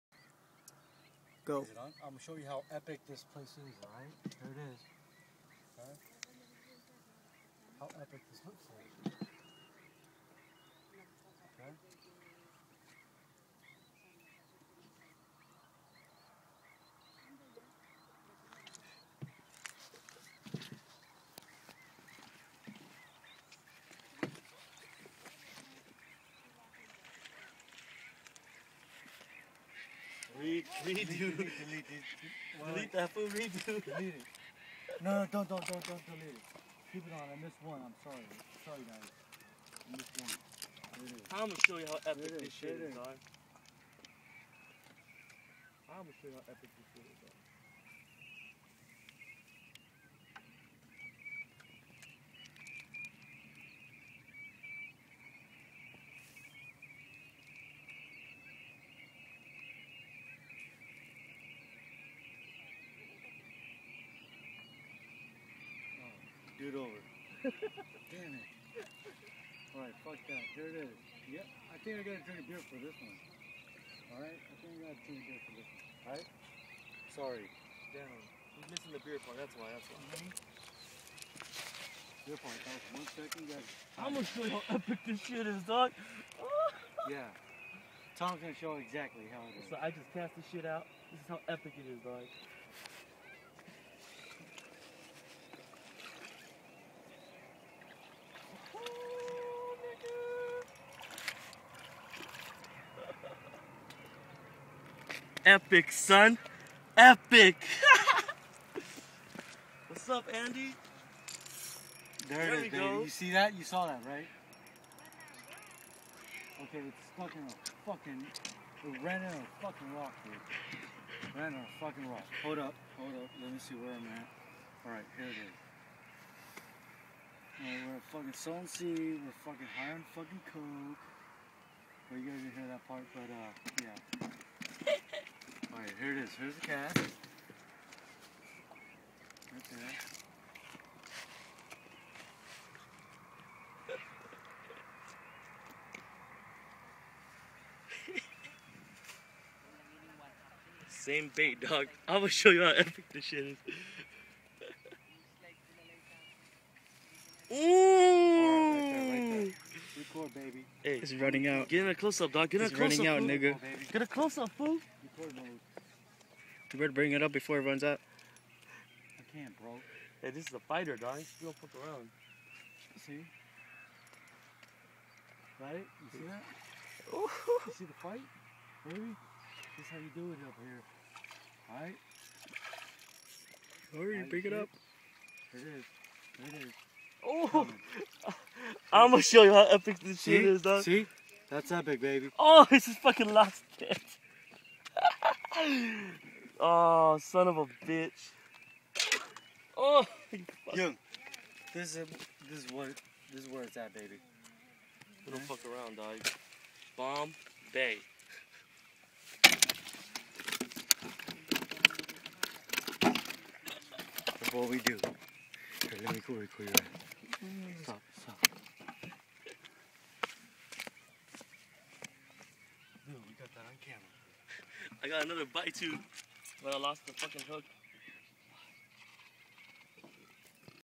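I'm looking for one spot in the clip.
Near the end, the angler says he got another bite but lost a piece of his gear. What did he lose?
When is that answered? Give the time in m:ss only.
3:47.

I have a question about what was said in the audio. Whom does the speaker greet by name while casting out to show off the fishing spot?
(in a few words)
Andy.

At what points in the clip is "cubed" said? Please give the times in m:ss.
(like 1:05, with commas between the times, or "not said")
not said.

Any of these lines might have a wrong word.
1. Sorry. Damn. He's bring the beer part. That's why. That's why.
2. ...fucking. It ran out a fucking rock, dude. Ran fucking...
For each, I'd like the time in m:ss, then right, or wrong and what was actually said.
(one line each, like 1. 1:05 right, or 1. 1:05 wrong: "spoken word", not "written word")
1. 1:17 wrong: "missing", not "bring"
2. 1:57 right.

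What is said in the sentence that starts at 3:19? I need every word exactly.
Oh, Yo, this is this is what this is where it's at, baby.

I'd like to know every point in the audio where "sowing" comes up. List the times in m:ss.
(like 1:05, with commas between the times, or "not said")
2:08.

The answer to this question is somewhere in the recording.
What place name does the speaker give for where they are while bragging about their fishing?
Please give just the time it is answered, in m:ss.
3:26.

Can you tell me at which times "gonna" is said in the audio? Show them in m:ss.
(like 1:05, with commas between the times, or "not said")
0:41, 0:46, 1:24, 1:28, 3:09.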